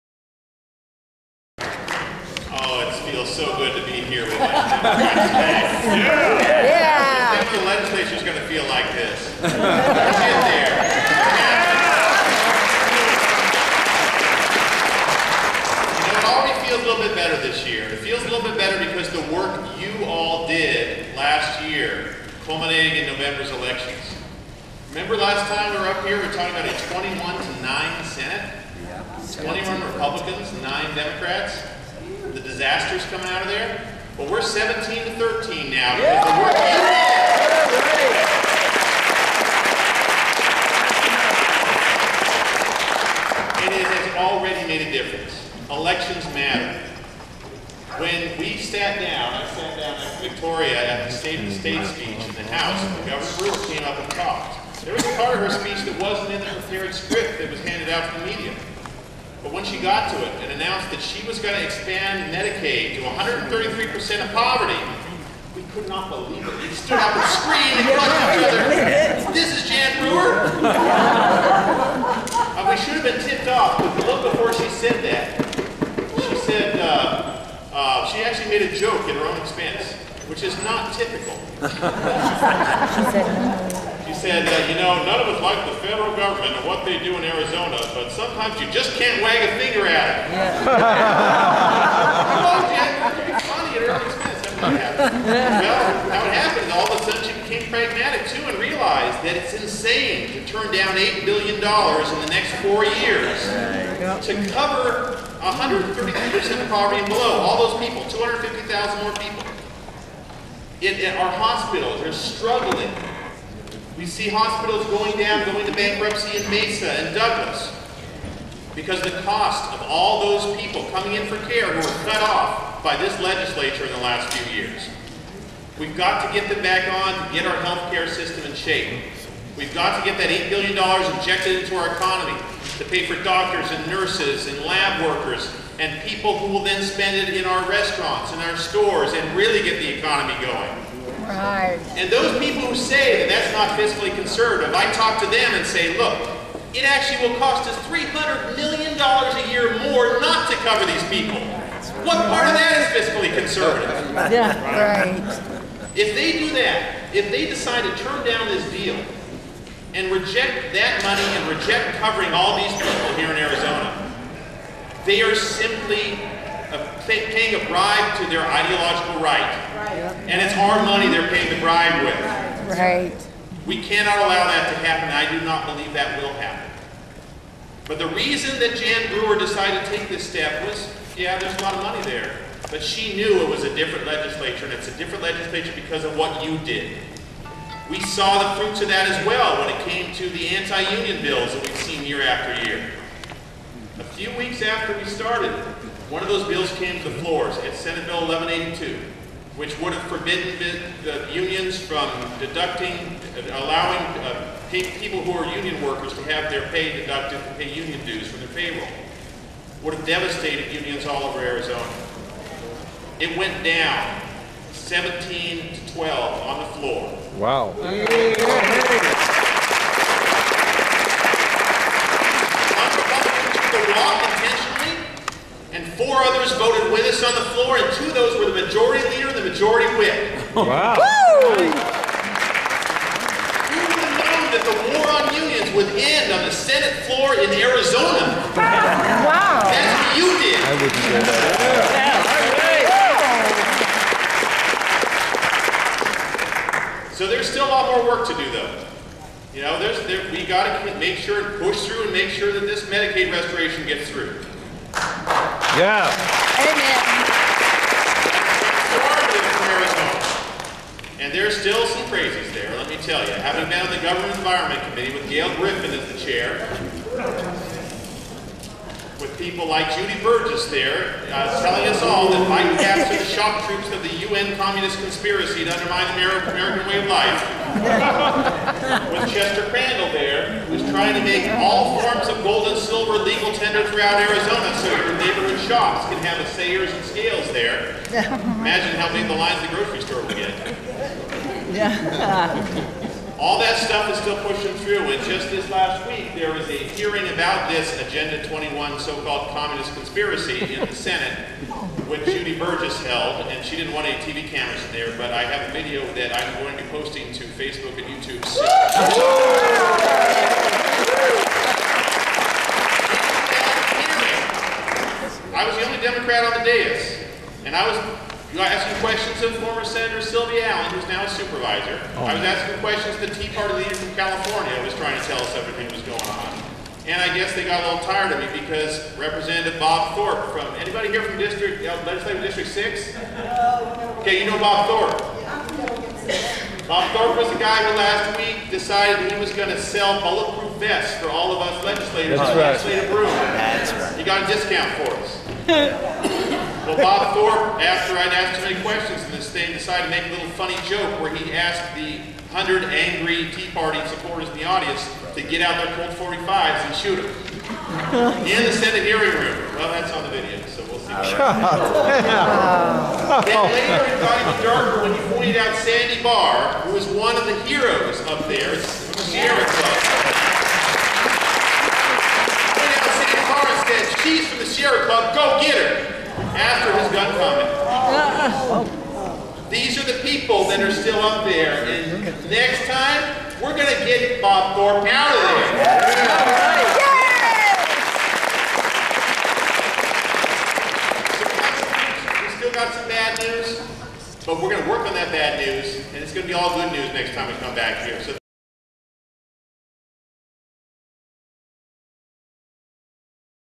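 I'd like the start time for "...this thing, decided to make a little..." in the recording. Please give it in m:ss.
5:49.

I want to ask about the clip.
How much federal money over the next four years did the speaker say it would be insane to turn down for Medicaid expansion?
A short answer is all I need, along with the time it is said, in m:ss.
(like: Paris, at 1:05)
$8 billion, at 1:40.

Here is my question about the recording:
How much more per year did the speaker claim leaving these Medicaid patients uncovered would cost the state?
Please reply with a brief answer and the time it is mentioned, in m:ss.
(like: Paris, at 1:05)
$300 million, at 2:27.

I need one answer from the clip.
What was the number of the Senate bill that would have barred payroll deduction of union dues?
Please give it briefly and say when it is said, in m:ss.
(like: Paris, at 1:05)
Senate Bill 1182, at 3:17.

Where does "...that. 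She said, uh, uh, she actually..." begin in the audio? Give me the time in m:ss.
1:15.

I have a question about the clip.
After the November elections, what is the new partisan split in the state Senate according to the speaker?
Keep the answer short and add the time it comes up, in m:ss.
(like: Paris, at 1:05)
17 to 13, at 0:34.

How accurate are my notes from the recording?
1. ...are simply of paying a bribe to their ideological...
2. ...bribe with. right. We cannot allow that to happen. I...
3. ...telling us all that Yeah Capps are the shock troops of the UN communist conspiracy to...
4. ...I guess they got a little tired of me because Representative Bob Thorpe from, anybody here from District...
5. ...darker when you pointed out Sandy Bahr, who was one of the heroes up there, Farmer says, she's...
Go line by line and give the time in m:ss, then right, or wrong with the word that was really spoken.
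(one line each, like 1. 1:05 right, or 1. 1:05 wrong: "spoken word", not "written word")
1. 2:45 right
2. 2:51 right
3. 4:31 wrong: "Mike", not "Yeah"
4. 5:27 right
5. 6:04 right.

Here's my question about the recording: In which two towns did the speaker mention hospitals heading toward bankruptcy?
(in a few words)
Mesa and Douglas.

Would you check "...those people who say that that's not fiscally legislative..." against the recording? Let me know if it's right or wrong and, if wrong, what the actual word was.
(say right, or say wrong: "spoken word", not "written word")
wrong: "conservative", not "legislative".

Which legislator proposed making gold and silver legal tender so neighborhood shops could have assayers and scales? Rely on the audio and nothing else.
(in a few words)
Chester Crandell.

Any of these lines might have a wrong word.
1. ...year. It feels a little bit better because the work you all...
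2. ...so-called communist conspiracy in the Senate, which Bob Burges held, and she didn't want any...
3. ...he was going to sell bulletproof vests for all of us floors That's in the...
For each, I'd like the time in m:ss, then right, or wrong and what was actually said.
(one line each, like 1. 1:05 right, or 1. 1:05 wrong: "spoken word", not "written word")
1. 0:17 right
2. 4:58 wrong: "Judy", not "Bob"
3. 5:39 wrong: "legislators", not "floors".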